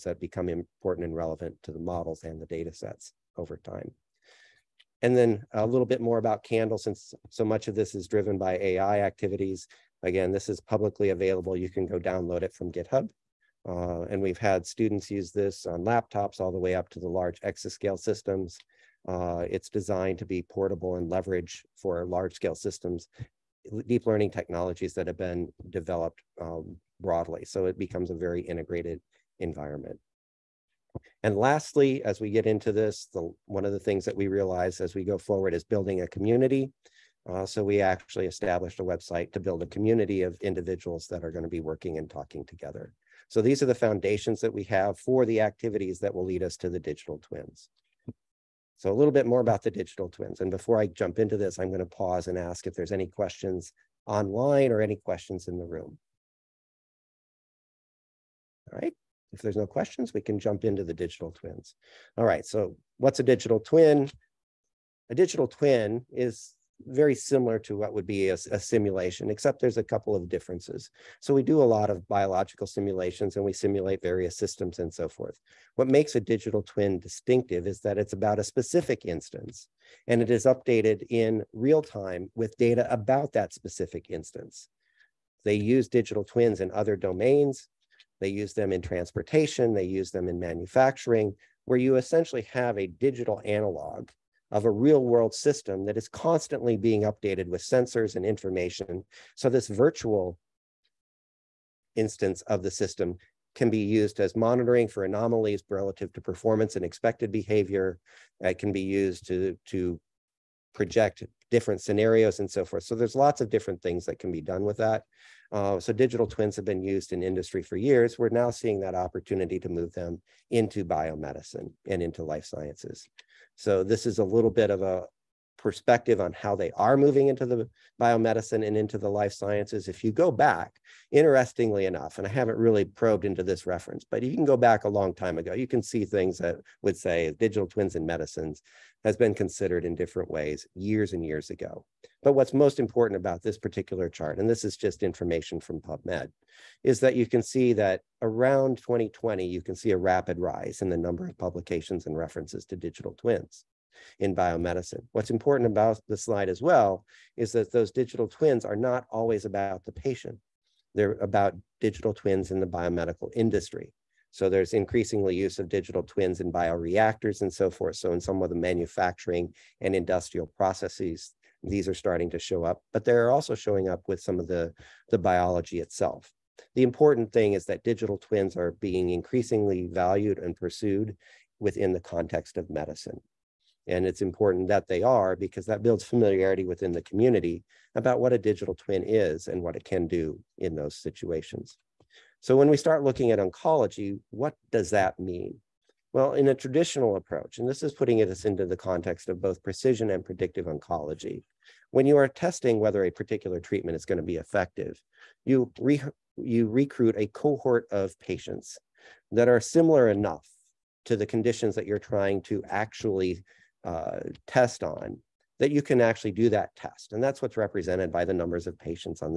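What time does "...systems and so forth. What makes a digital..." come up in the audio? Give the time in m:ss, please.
1:14.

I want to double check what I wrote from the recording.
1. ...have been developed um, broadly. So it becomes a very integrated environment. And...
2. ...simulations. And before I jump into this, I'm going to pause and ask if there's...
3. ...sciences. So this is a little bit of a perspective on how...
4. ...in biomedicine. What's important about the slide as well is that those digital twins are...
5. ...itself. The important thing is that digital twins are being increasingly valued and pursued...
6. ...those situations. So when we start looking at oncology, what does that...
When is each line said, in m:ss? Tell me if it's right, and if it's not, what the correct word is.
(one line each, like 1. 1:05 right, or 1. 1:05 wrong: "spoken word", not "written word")
1. 0:25 right
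2. 0:50 wrong: "twins", not "simulations"
3. 2:02 right
4. 2:34 right
5. 2:55 right
6. 3:10 right.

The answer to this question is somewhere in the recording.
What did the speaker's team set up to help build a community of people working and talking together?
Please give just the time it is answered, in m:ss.
0:38.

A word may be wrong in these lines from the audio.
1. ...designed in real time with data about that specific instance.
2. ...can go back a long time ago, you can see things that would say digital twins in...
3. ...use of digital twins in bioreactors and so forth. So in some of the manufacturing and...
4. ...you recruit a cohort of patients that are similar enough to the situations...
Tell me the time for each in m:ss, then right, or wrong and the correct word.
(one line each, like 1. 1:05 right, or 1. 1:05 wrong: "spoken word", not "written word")
1. 1:20 wrong: "updated", not "designed"
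2. 2:14 right
3. 2:45 right
4. 3:26 wrong: "conditions", not "situations".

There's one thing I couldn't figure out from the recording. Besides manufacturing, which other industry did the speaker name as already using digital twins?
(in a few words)
Transportation.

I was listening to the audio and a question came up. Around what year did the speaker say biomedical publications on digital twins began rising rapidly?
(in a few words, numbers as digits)
2020.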